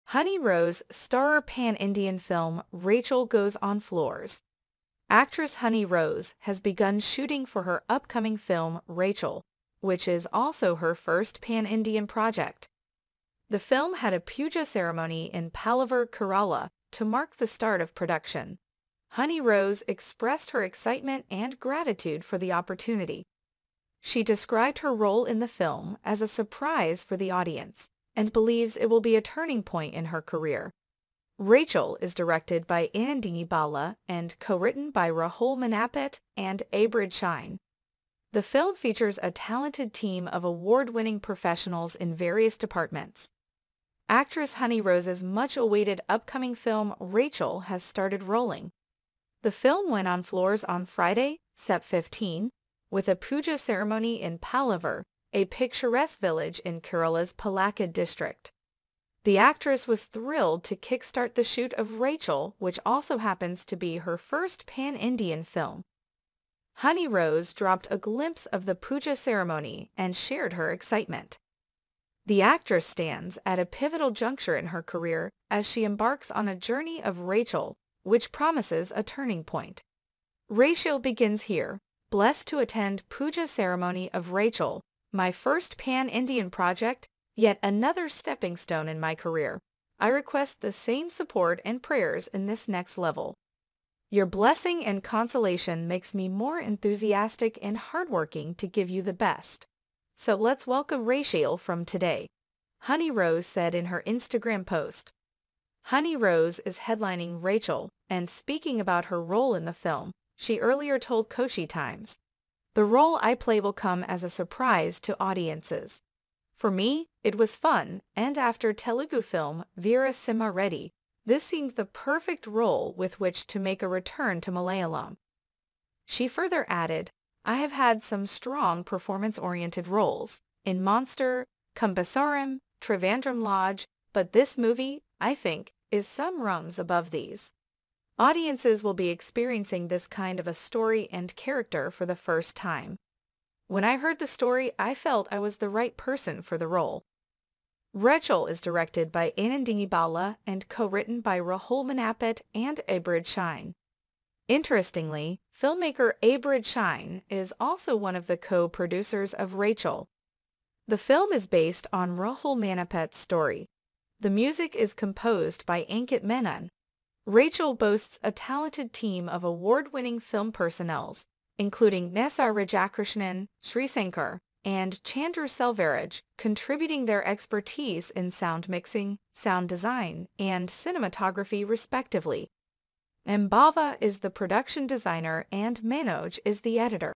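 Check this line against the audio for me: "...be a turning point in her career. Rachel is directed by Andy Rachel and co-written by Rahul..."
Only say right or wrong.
wrong.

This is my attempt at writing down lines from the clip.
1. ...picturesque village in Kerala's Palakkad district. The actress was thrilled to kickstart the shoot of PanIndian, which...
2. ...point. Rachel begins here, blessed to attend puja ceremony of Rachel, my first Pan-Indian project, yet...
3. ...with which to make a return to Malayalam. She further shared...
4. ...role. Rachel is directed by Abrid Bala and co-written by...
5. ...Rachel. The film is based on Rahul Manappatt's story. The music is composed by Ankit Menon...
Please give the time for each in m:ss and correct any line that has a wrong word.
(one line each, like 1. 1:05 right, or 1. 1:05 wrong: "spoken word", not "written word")
1. 0:55 wrong: "Rachel", not "PanIndian"
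2. 1:19 right
3. 2:02 wrong: "added", not "shared"
4. 2:26 wrong: "Anandini", not "Abrid"
5. 2:39 right.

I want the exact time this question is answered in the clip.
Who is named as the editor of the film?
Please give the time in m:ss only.
3:05.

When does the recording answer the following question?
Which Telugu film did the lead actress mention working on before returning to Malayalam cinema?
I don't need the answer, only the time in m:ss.
1:59.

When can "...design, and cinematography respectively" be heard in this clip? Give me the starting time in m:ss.
2:59.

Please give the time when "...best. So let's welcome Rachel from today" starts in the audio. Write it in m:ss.
1:39.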